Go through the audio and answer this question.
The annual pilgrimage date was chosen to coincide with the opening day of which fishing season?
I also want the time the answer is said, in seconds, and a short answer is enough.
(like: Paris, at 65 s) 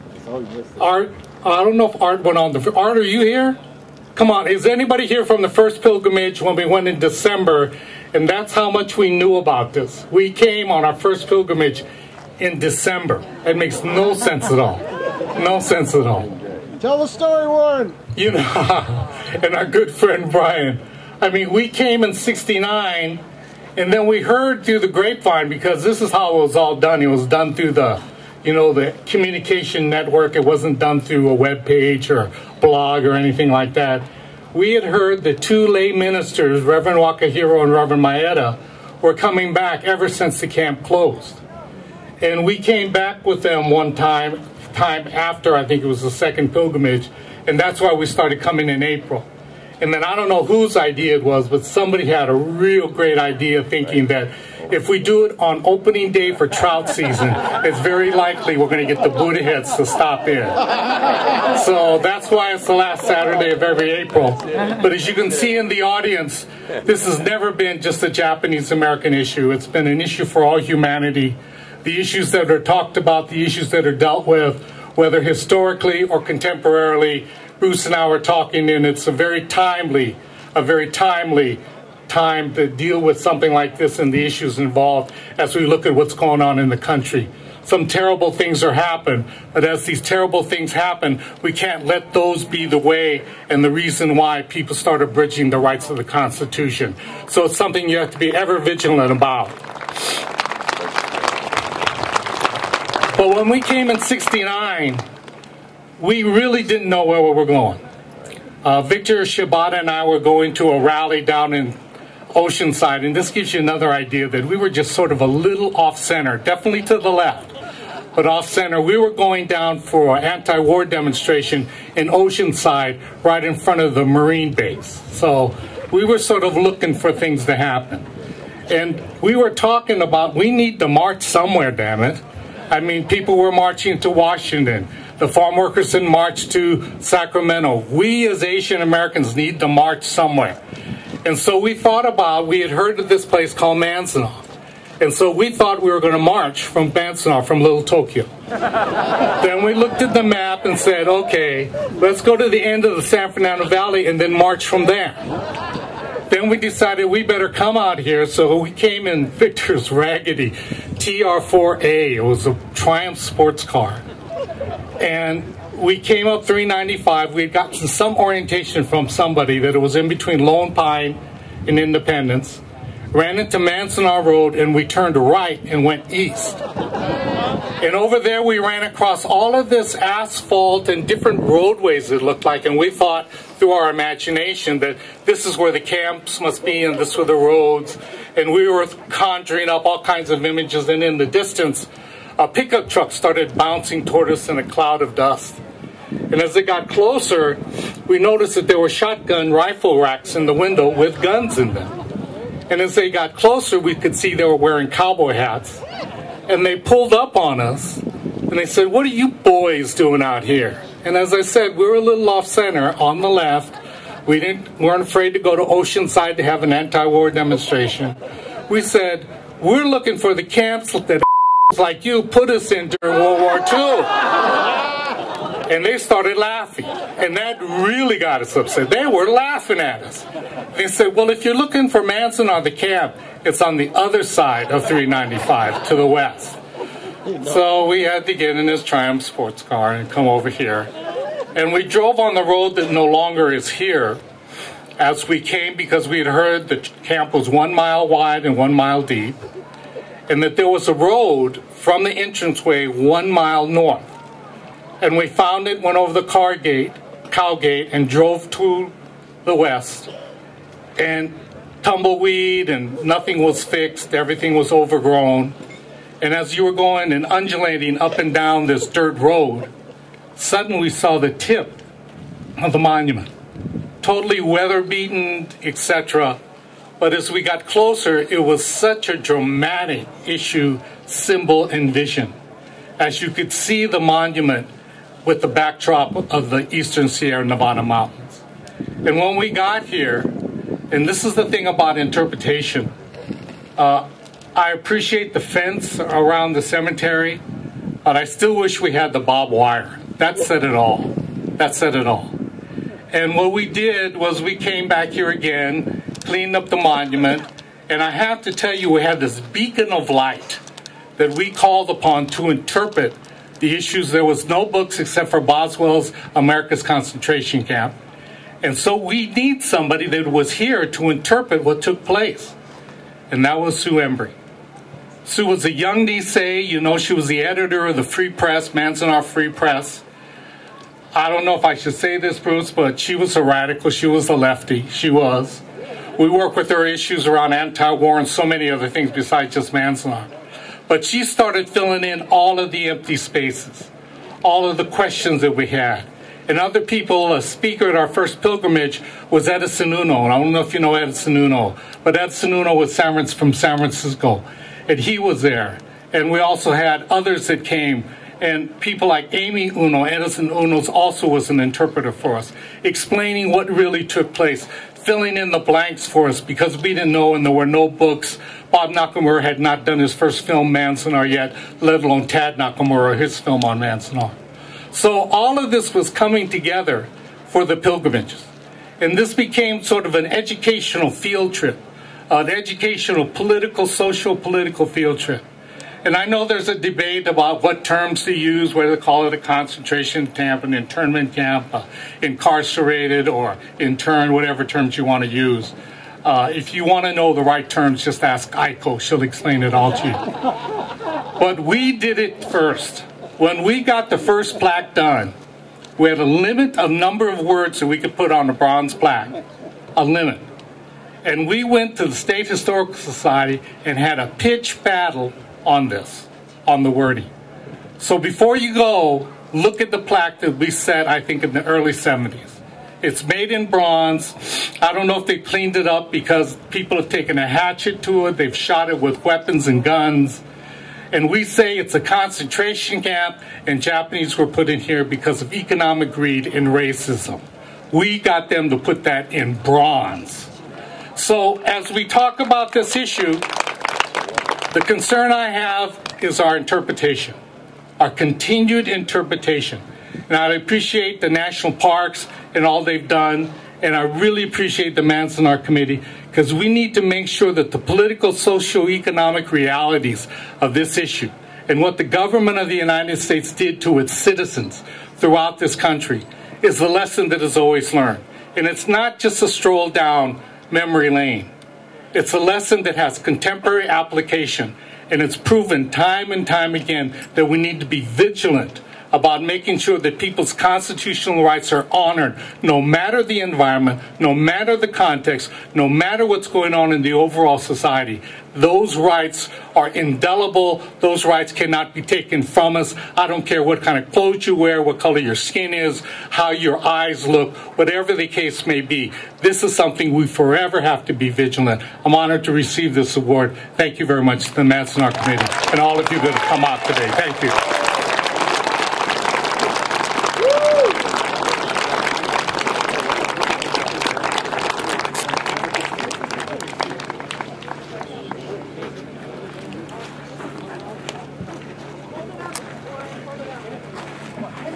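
Trout season, at 56 s.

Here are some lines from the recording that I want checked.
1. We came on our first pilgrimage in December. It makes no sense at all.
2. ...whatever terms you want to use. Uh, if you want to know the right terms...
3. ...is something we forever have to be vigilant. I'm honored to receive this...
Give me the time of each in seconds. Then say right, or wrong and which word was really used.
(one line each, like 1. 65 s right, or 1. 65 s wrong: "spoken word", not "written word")
1. 10 s right
2. 394 s right
3. 499 s right.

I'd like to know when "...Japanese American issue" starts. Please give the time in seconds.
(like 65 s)
68 s.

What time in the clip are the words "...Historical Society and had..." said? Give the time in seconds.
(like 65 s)
412 s.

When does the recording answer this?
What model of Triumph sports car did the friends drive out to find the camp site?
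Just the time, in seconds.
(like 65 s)
160 s.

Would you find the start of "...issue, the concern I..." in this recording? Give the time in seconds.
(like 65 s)
442 s.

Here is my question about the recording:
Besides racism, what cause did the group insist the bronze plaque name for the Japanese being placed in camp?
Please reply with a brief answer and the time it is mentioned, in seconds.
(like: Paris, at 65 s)
Economic greed, at 435 s.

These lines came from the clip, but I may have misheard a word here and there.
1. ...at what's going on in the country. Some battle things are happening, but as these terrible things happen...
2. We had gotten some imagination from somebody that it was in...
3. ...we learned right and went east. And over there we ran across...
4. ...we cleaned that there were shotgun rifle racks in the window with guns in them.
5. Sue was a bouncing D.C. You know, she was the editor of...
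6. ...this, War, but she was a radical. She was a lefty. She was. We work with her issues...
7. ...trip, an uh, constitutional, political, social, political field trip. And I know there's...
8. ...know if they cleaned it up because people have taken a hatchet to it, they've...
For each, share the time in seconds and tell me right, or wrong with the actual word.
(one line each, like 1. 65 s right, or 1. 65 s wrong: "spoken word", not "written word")
1. 85 s wrong: "terrible", not "battle"
2. 167 s wrong: "orientation", not "imagination"
3. 174 s wrong: "turned", not "learned"
4. 198 s wrong: "noticed", not "cleaned"
5. 325 s wrong: "young", not "bouncing"
6. 332 s wrong: "Bruce", not "War"
7. 381 s wrong: "educational", not "constitutional"
8. 425 s right.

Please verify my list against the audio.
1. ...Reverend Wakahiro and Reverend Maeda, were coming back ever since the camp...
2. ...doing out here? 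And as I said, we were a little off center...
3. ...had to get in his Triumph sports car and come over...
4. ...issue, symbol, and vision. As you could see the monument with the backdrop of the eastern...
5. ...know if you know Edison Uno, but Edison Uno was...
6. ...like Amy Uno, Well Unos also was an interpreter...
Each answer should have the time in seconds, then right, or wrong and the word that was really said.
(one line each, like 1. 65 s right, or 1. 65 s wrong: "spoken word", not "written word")
1. 36 s right
2. 209 s right
3. 238 s right
4. 280 s right
5. 350 s right
6. 359 s wrong: "Edison", not "Well".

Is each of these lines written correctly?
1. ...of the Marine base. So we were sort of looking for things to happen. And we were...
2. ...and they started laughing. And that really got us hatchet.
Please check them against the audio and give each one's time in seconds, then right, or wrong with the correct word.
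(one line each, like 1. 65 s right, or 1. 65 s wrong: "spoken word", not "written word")
1. 123 s right
2. 225 s wrong: "upset", not "hatchet".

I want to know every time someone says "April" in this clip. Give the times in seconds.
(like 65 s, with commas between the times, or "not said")
48 s, 63 s.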